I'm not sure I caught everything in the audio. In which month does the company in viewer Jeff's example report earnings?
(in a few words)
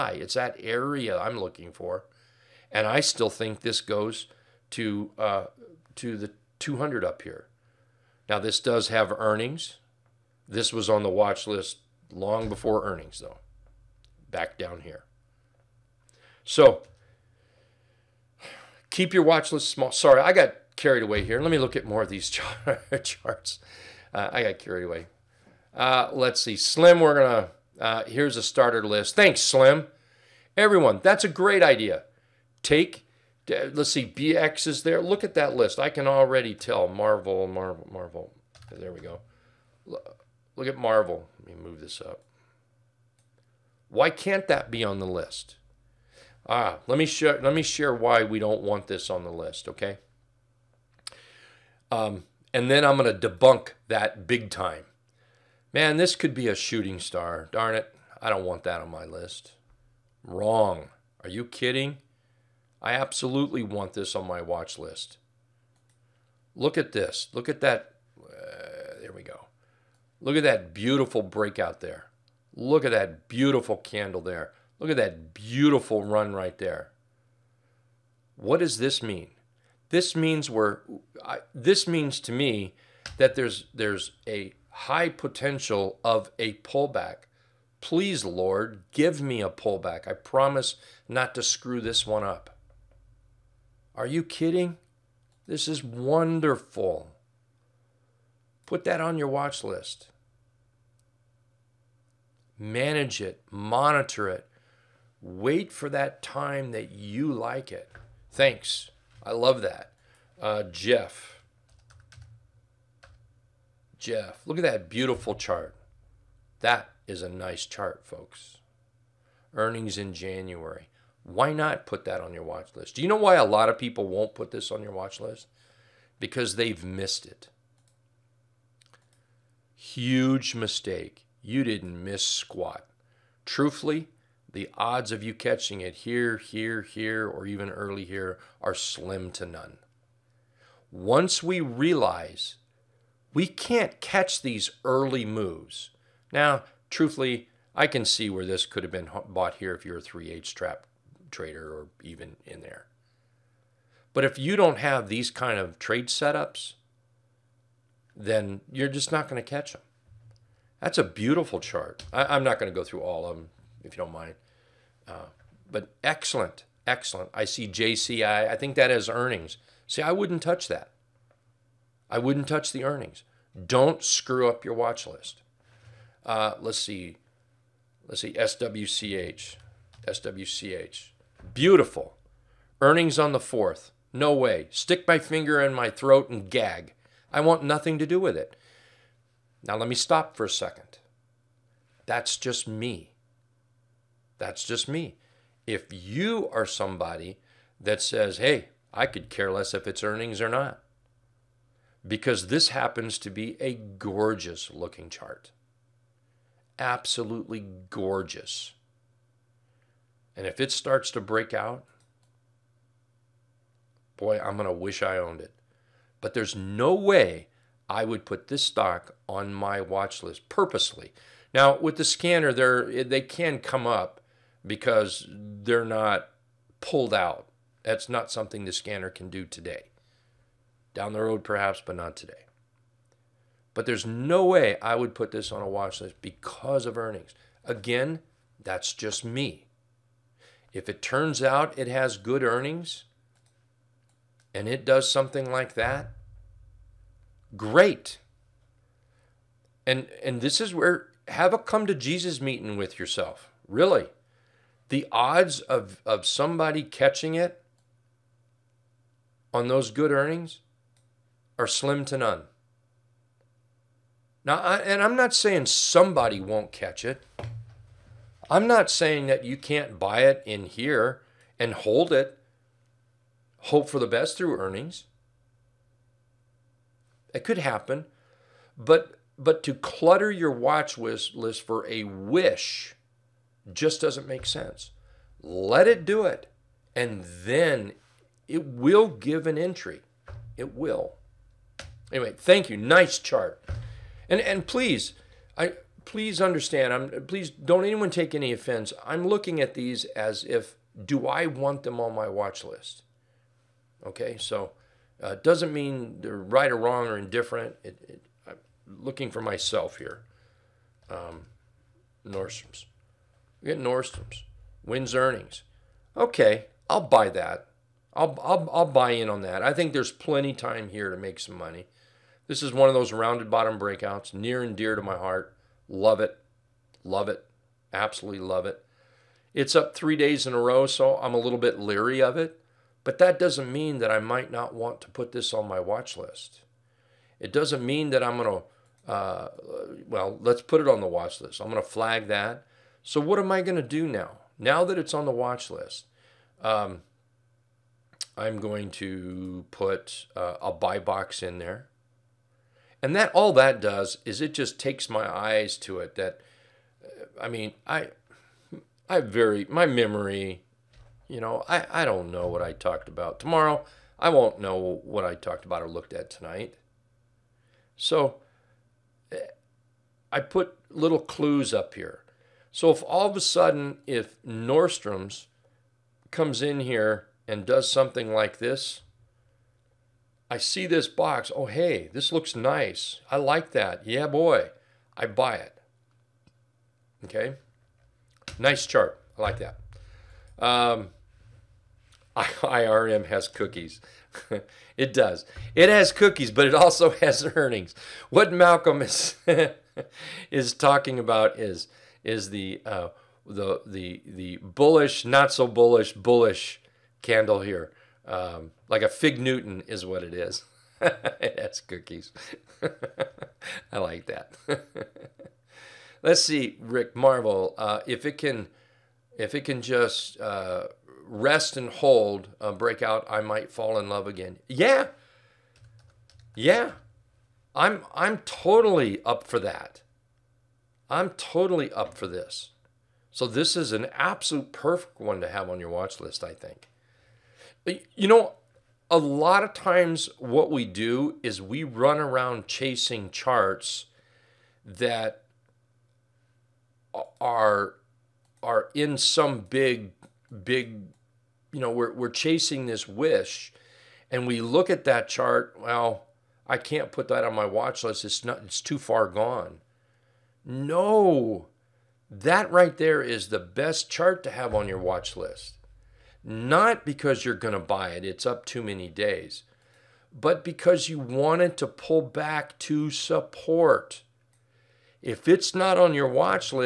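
January.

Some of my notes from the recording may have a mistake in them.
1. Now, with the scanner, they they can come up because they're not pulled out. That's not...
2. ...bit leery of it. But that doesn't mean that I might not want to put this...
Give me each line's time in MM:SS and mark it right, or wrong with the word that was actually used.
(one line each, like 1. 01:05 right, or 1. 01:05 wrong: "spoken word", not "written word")
1. 03:41 right
2. 05:31 right.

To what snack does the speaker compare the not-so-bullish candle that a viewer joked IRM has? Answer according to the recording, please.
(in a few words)
Fig Newton.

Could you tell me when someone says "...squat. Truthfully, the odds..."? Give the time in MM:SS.
02:12.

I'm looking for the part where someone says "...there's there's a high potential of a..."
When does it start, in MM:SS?
01:23.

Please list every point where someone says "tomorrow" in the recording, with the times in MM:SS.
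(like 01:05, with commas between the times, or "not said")
06:03.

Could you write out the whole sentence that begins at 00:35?
I can already tell Marvell, Marvell, Marvell.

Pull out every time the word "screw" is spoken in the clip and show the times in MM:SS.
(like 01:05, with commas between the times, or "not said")
01:31, 02:54.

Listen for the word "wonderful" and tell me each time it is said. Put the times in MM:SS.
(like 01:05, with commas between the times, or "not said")
01:35.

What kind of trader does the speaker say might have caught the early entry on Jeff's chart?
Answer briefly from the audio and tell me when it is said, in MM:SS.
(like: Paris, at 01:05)
3 8 trap trader, at 02:30.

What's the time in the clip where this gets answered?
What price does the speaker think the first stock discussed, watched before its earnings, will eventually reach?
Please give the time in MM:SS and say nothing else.
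00:06.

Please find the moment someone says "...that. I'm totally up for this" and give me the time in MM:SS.
07:09.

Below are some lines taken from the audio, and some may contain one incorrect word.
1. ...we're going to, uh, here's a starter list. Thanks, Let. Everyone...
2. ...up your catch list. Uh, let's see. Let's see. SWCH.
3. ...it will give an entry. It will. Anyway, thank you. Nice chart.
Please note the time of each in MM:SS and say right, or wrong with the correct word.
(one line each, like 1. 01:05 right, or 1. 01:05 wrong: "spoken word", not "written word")
1. 00:26 wrong: "Slim", not "Let"
2. 02:54 wrong: "watch", not "catch"
3. 04:48 right.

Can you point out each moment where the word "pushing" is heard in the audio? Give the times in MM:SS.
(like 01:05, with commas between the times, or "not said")
not said.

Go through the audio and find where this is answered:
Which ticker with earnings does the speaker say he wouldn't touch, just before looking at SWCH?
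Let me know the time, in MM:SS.
02:47.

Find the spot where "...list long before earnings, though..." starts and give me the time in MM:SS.
00:11.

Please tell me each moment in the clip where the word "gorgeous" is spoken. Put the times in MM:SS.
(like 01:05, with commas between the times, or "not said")
03:23, 03:27.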